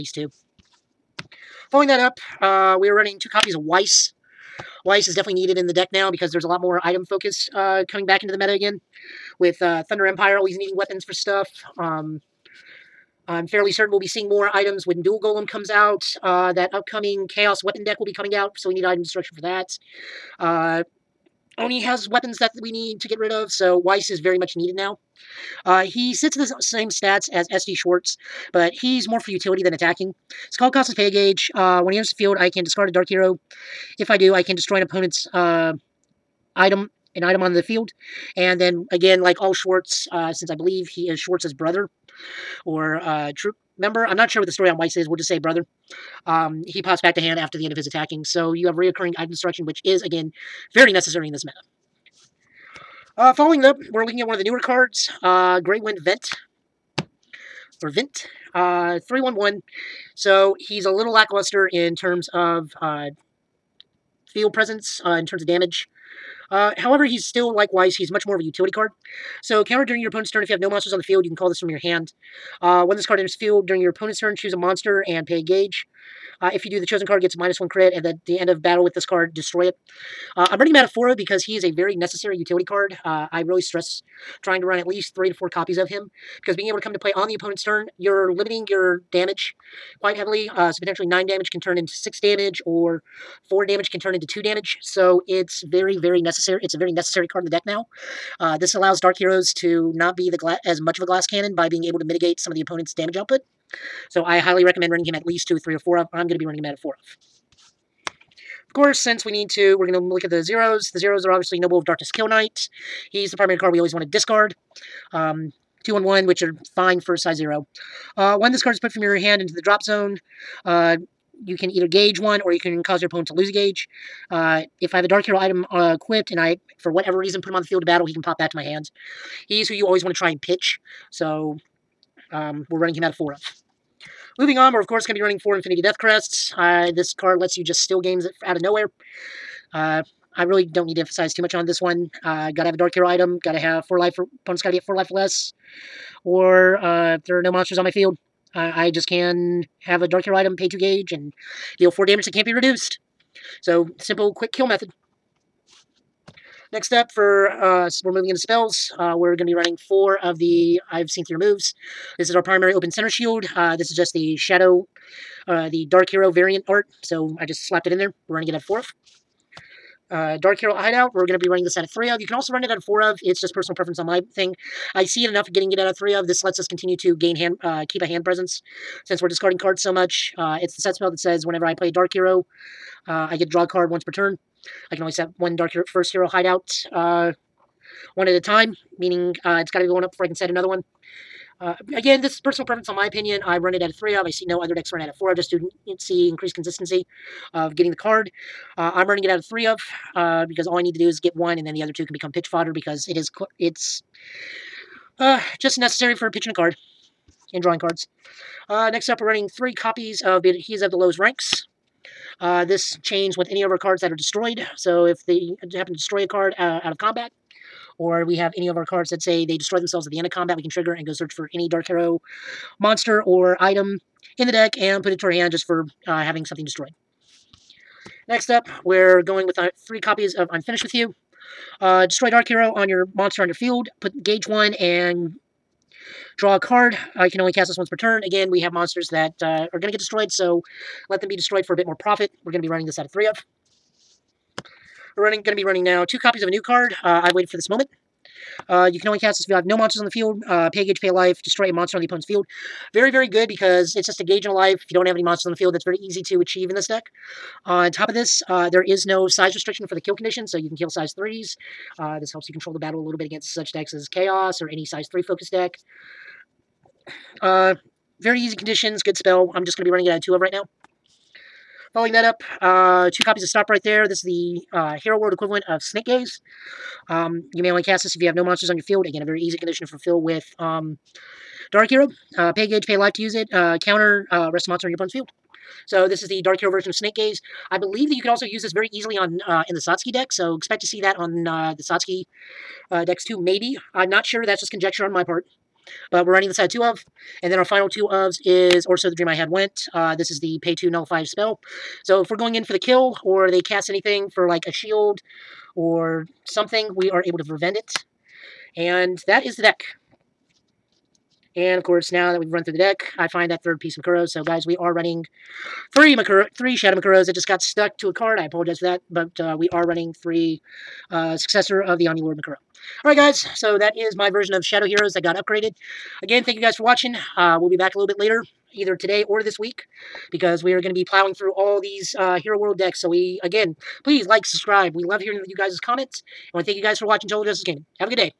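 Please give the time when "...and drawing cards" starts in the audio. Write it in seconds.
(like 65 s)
207 s.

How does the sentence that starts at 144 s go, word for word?
for opponents gotta be at four life or less.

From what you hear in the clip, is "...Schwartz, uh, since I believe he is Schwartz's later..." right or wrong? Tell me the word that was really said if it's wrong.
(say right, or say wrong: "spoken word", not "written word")
wrong: "brother", not "later".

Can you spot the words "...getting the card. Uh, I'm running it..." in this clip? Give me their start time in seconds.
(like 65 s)
197 s.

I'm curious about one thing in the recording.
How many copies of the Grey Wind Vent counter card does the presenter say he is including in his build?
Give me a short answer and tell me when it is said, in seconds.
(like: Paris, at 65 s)
4, at 80 s.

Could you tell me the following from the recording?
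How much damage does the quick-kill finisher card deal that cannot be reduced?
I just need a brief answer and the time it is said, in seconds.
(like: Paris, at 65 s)
4, at 151 s.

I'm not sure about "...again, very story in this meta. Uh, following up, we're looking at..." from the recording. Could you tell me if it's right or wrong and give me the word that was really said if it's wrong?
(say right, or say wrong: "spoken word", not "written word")
wrong: "necessary", not "story".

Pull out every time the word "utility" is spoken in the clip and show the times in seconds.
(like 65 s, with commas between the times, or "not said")
29 s, 68 s, 82 s.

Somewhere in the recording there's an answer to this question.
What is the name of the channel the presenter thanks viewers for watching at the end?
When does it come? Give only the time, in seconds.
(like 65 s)
337 s.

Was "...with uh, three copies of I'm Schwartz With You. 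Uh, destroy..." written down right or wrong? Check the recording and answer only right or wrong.
wrong.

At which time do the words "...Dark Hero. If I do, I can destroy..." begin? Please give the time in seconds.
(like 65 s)
32 s.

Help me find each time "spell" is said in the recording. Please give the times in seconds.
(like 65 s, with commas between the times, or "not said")
158 s, 180 s, 269 s, 301 s.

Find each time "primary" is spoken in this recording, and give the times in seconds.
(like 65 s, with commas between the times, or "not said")
113 s, 162 s.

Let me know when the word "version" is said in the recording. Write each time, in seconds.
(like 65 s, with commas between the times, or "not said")
286 s, 324 s.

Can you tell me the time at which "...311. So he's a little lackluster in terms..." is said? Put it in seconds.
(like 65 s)
58 s.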